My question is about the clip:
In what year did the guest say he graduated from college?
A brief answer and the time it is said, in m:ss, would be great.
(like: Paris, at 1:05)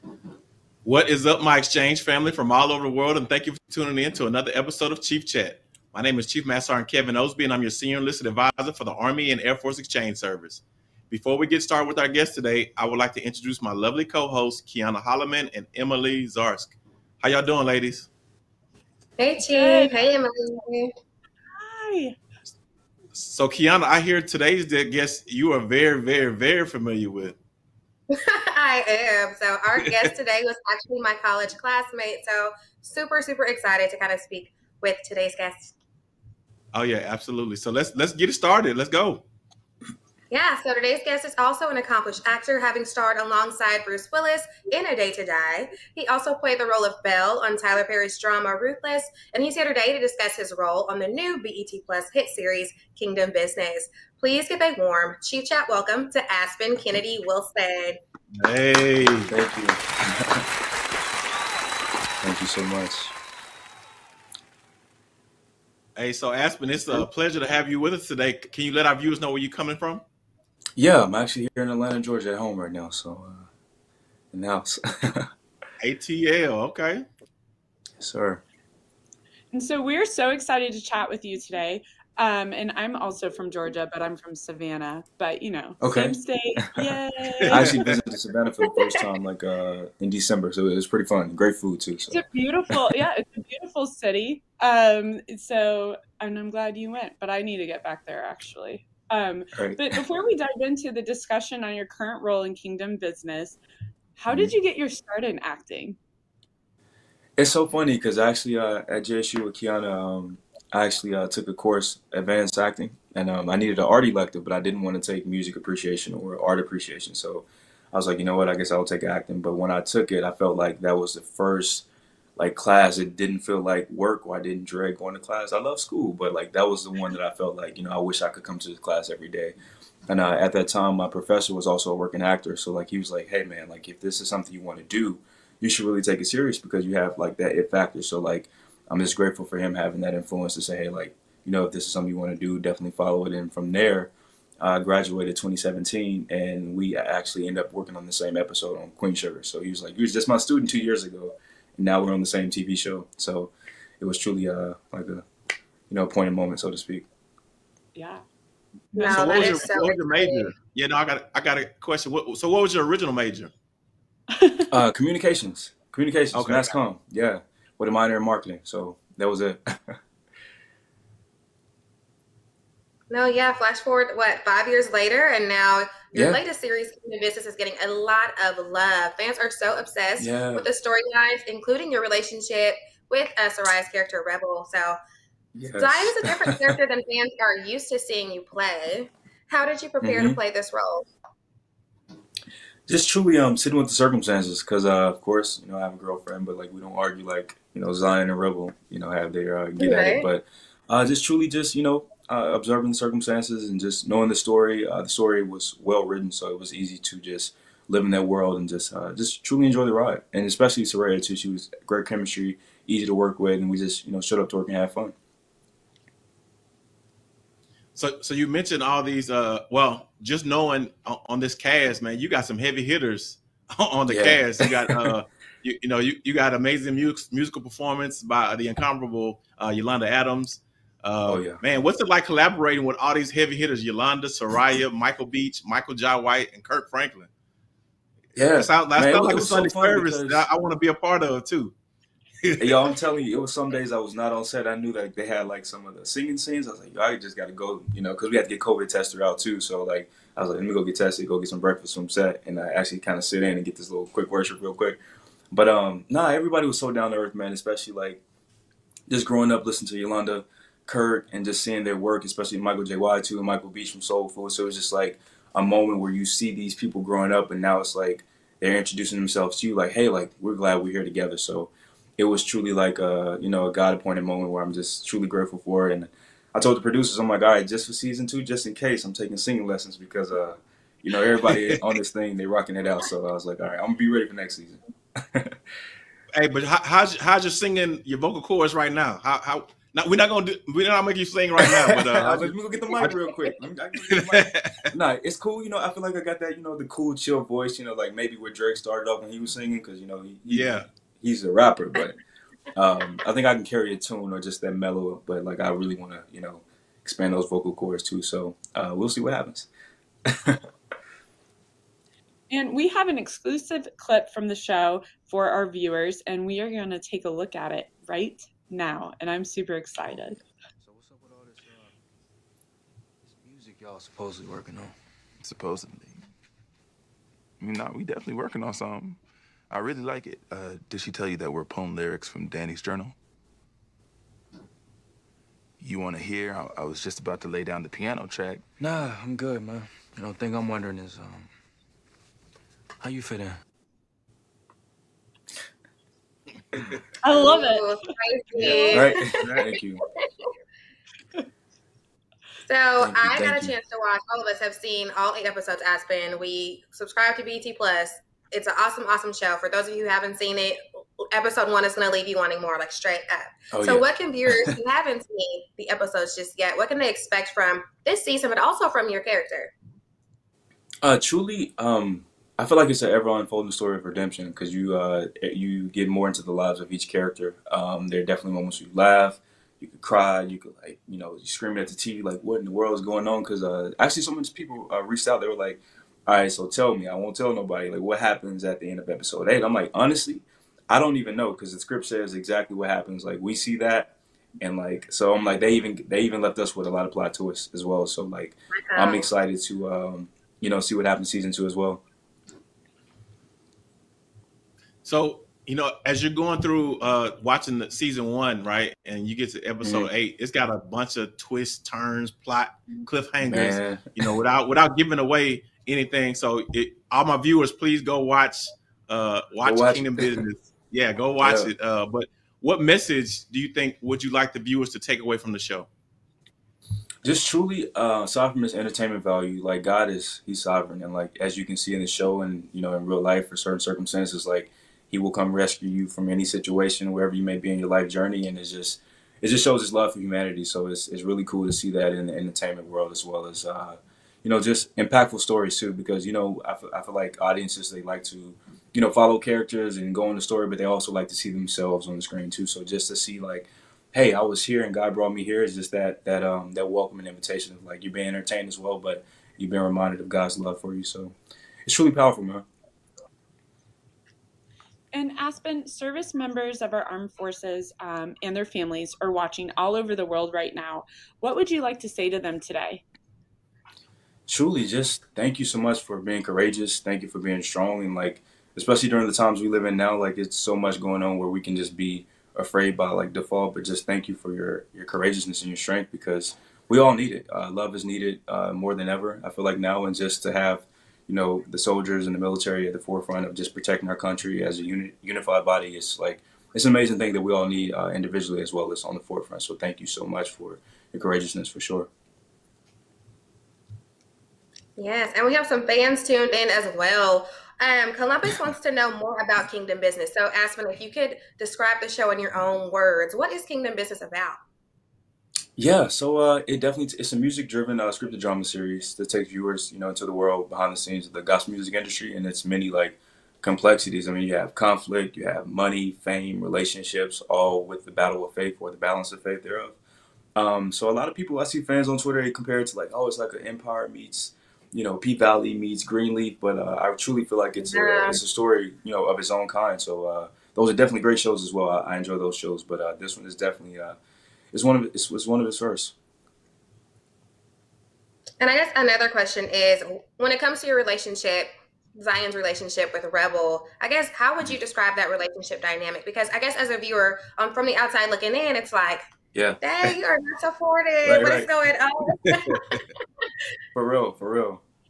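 2017, at 2:25.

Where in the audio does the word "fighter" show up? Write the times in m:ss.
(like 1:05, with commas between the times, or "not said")
not said.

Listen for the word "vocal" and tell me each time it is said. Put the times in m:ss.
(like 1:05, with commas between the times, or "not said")
4:48, 5:07.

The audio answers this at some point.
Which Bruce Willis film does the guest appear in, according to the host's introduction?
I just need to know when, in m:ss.
0:44.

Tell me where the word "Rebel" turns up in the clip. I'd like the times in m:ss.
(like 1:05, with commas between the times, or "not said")
3:04, 3:18, 9:13.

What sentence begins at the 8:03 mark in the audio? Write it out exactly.
But just thank you for your, your courageousness and your strength because we all need it.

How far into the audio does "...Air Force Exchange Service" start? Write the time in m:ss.
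0:09.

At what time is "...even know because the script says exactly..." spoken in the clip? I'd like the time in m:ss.
6:31.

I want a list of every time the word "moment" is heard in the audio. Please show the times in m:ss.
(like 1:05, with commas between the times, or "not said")
2:36, 4:25, 4:34, 6:18.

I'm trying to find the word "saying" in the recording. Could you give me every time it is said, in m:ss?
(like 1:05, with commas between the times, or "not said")
not said.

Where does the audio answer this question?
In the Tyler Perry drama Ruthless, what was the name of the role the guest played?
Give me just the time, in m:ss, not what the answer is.
0:47.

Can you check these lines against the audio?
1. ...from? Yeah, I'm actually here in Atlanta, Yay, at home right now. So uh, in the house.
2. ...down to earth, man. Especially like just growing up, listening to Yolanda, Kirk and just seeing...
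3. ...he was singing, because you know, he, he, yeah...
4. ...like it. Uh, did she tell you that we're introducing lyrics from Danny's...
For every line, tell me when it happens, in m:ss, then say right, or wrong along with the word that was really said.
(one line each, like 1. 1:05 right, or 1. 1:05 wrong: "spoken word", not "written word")
1. 1:09 wrong: "Georgia", not "Yay"
2. 4:16 right
3. 4:59 right
4. 5:30 wrong: "pulling", not "introducing".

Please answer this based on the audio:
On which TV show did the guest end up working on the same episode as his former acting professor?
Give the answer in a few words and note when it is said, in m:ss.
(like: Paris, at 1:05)
Queen Sugar, at 2:28.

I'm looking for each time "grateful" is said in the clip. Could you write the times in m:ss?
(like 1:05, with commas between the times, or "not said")
2:19, 4:35.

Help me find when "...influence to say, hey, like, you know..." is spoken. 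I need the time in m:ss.
2:20.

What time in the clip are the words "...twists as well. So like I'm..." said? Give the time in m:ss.
6:37.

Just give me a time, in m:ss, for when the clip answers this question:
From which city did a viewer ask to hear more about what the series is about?
8:28.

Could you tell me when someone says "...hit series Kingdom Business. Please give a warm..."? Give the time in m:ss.
0:52.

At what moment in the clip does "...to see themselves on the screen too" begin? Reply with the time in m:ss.
7:31.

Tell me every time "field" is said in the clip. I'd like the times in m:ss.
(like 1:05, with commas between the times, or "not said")
not said.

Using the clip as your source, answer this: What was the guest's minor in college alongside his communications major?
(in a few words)
Marketing.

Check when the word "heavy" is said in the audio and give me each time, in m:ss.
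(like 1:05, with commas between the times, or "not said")
3:42, 3:53.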